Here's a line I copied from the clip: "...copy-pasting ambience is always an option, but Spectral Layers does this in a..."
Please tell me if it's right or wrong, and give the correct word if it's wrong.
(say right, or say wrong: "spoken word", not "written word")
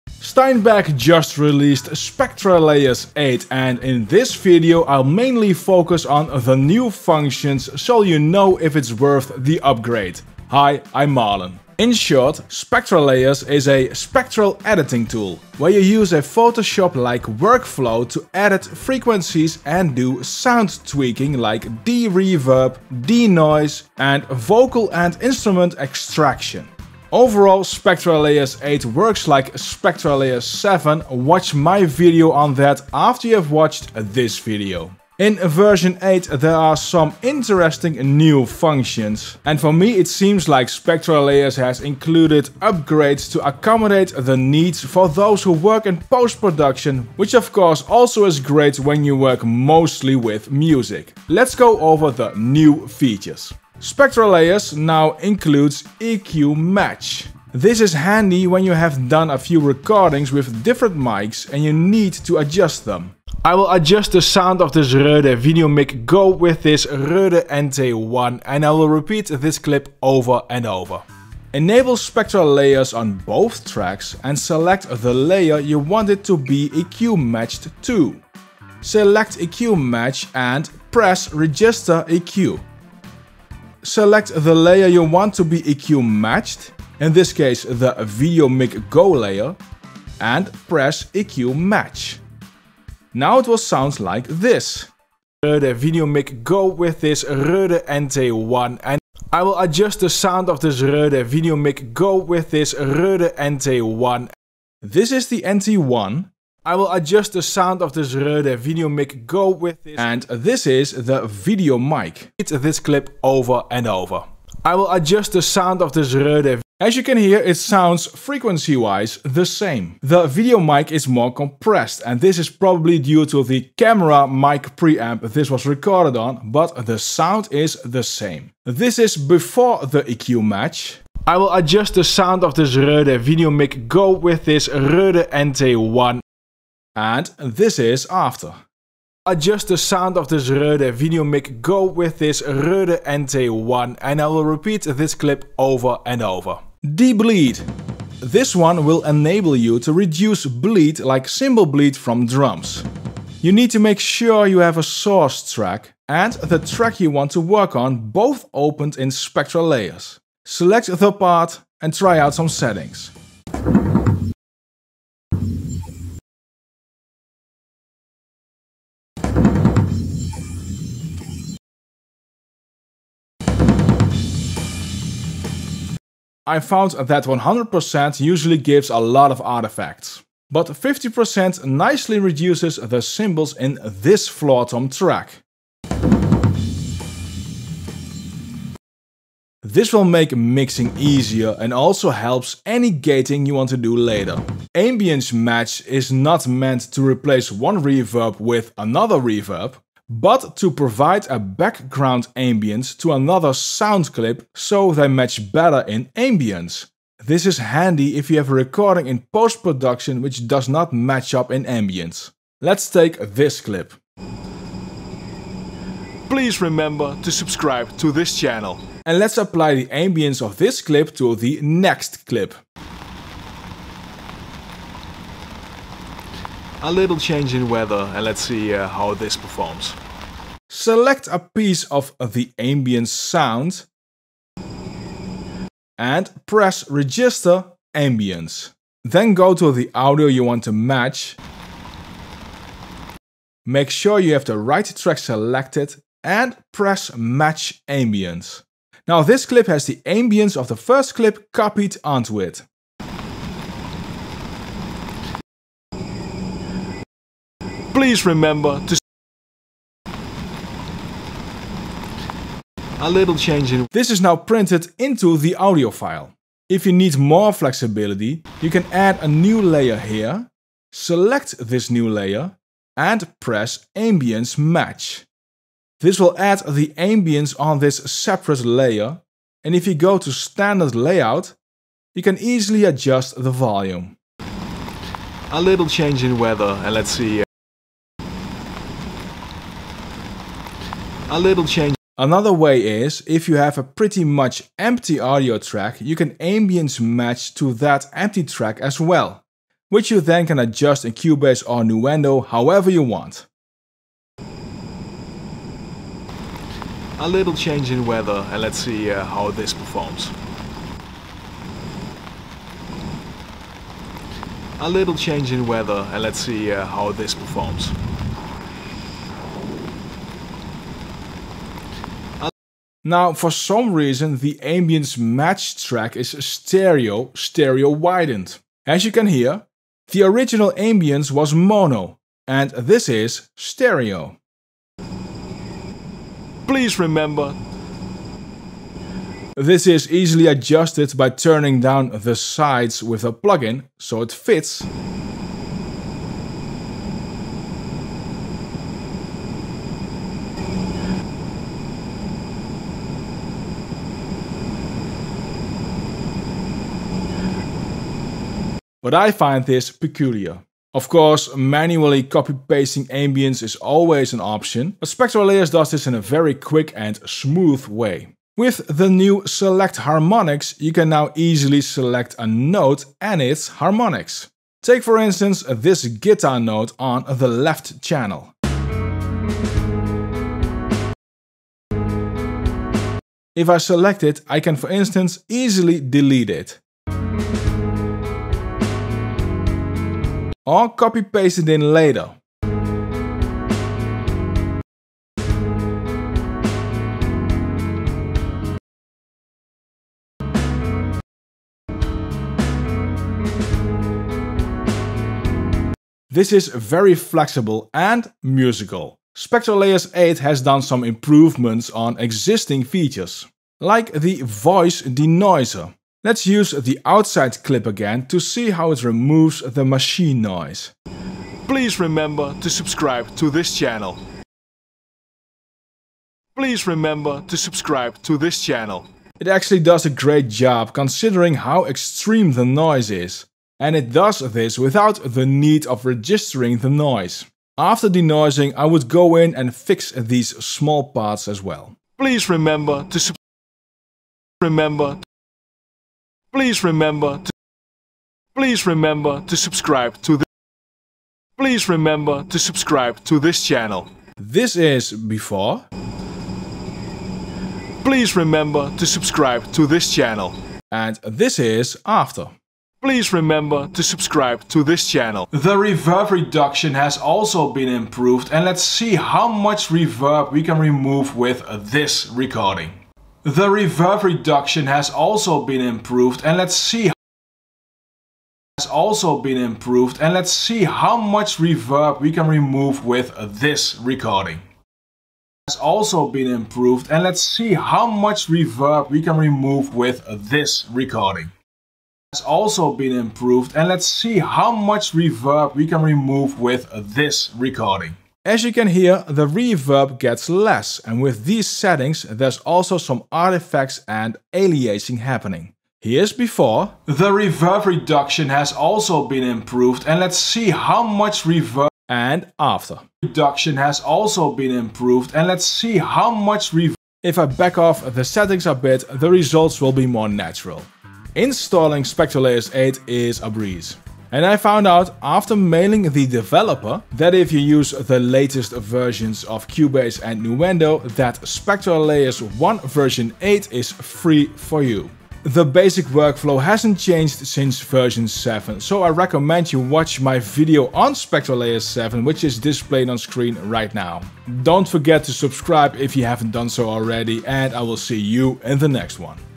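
right.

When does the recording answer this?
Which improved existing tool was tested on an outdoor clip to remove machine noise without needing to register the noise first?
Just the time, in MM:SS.
06:54.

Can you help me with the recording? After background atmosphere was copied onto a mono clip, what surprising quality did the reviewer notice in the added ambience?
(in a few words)
stereo widened.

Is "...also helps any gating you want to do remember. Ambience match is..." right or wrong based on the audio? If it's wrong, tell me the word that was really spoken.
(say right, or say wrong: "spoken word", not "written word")
wrong: "later", not "remember".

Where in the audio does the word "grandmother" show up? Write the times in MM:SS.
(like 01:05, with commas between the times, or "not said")
not said.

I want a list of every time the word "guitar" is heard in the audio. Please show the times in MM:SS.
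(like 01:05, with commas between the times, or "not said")
06:16.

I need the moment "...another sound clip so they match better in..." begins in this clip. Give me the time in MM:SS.
03:23.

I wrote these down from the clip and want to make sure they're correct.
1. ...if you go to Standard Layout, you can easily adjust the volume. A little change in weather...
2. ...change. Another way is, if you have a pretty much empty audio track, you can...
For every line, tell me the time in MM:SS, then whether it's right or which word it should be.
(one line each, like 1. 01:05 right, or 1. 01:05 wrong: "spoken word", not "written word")
1. 04:39 right
2. 04:51 right.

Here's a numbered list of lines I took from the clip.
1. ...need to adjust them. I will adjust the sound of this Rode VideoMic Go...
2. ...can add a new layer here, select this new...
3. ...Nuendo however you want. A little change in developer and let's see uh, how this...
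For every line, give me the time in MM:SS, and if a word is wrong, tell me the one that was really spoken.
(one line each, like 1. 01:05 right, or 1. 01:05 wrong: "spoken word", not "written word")
1. 01:01 right
2. 04:28 right
3. 05:01 wrong: "weather", not "developer".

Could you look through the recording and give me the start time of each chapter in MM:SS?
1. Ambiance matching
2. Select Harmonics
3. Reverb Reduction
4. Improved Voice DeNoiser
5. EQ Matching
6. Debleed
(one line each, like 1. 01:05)
1. 03:27
2. 06:08
3. 07:48
4. 06:51
5. 00:53
6. 02:26.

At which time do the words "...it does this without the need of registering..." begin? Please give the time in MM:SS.
07:13.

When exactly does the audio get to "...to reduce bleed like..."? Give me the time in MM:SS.
02:29.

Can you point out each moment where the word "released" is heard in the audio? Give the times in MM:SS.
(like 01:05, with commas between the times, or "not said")
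00:01.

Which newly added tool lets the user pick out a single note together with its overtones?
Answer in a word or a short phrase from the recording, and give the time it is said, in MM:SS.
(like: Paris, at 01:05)
Select Harmonics, at 06:09.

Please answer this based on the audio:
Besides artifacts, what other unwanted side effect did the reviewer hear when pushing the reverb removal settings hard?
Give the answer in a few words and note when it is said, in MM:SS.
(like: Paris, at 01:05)
aliasing, at 08:24.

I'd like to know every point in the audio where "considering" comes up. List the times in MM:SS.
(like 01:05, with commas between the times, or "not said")
07:10.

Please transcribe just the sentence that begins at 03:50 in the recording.
Select a piece of the ambient sound and press register ambience.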